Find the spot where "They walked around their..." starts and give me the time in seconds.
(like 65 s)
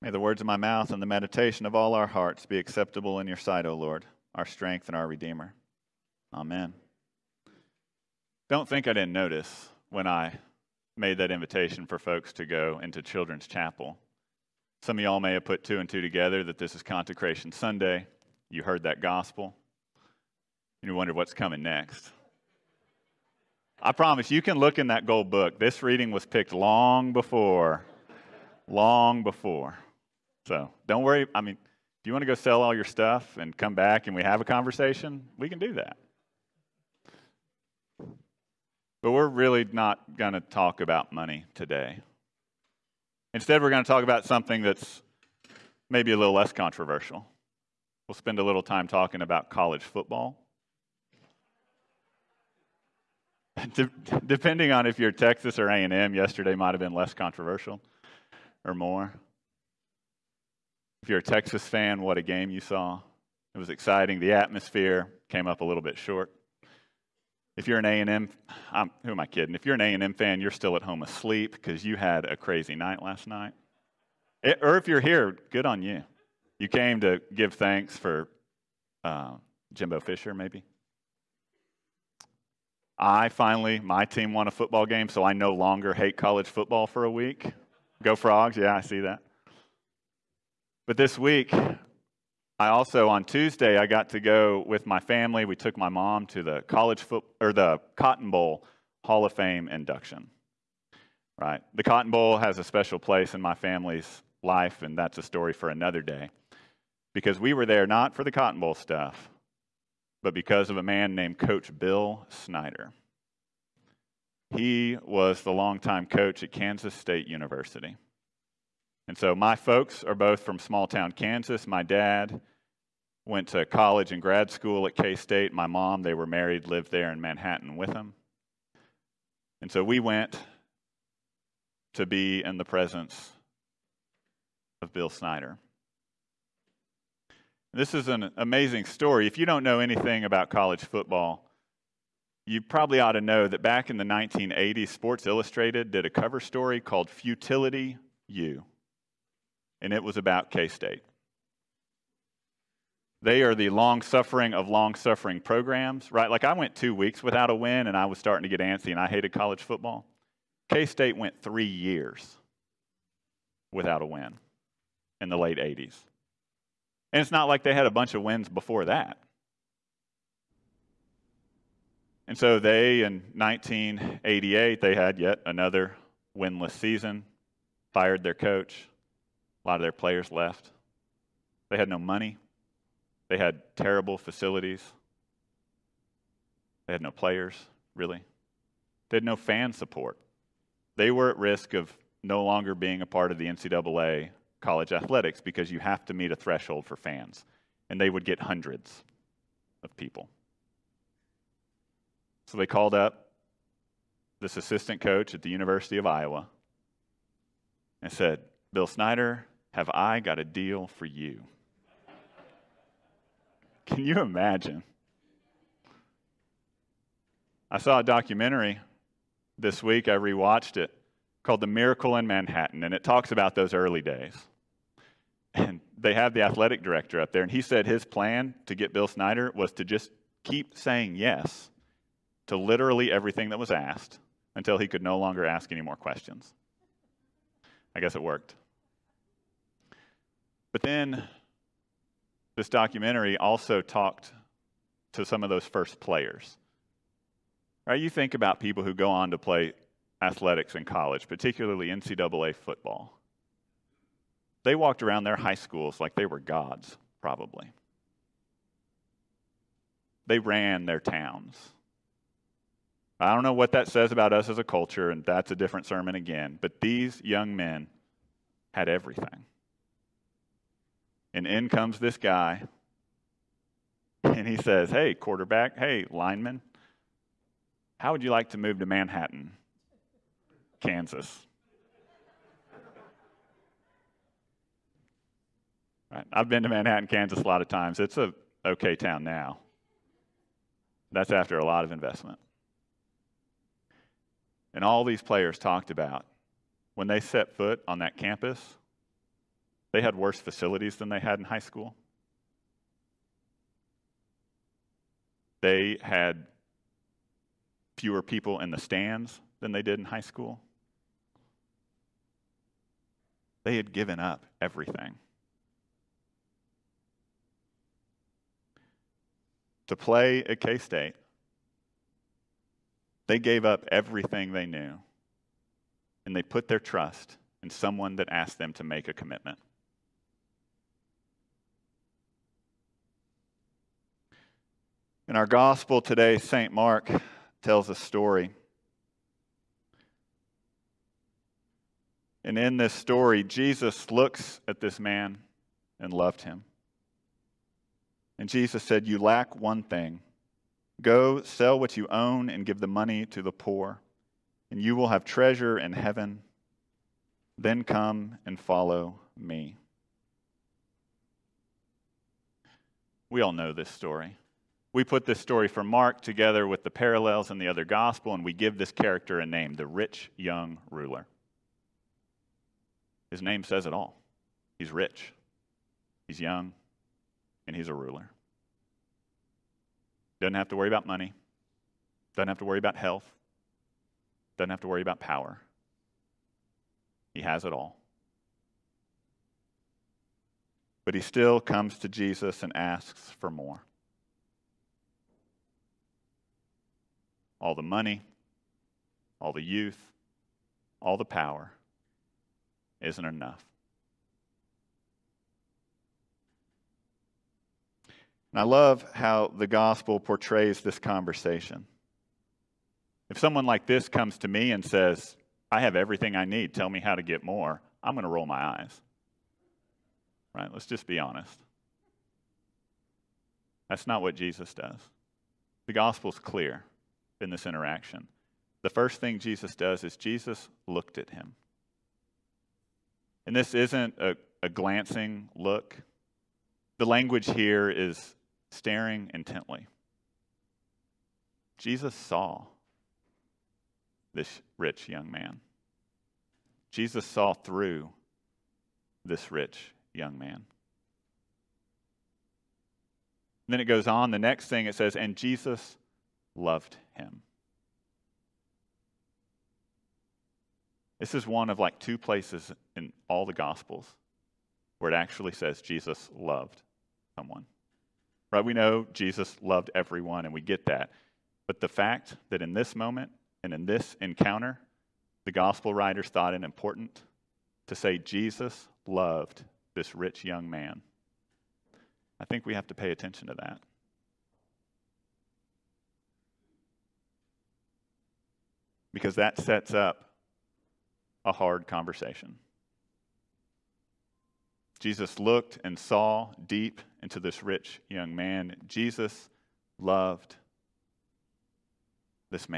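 254 s.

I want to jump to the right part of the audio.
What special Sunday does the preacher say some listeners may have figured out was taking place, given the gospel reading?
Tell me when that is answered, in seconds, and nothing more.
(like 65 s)
16 s.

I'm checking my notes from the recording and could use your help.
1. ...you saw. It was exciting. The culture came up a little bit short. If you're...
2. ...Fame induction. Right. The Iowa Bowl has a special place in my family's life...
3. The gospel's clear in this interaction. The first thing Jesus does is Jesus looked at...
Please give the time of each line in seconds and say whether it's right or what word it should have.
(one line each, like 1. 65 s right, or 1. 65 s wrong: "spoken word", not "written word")
1. 62 s wrong: "atmosphere", not "culture"
2. 99 s wrong: "Cotton", not "Iowa"
3. 425 s right.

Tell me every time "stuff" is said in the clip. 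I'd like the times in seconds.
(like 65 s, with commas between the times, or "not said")
32 s, 108 s.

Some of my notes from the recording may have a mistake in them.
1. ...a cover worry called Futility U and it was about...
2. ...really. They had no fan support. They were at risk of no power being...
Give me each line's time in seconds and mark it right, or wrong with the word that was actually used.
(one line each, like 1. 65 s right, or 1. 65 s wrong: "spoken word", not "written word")
1. 146 s wrong: "story", not "worry"
2. 187 s wrong: "longer", not "power".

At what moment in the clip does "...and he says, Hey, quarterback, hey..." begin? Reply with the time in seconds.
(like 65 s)
274 s.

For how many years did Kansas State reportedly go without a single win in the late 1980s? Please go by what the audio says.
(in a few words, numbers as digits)
3.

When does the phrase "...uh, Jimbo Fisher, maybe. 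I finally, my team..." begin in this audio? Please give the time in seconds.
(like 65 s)
79 s.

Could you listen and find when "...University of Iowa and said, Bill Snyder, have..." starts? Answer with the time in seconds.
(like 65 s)
205 s.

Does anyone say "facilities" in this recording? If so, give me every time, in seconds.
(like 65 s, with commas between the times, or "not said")
184 s, 300 s.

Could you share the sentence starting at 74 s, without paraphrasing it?
It, eh, or if you're here, good on you.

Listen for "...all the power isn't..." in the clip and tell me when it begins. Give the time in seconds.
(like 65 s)
401 s.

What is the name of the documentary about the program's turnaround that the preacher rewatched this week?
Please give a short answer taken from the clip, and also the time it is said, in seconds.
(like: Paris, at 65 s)
The Miracle in Manhattan, at 221 s.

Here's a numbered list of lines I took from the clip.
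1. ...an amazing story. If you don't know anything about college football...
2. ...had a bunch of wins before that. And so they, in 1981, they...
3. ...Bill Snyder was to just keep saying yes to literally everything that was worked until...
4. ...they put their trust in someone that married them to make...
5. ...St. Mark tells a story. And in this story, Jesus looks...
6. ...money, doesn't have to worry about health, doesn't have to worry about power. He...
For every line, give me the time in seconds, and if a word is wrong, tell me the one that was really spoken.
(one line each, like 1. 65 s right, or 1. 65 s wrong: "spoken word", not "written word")
1. 138 s right
2. 167 s wrong: "1988", not "1981"
3. 228 s wrong: "asked", not "worked"
4. 326 s wrong: "asked", not "married"
5. 336 s right
6. 381 s right.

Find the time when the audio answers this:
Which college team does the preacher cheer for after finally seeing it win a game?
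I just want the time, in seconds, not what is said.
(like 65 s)
88 s.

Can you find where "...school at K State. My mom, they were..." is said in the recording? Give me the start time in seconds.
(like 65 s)
124 s.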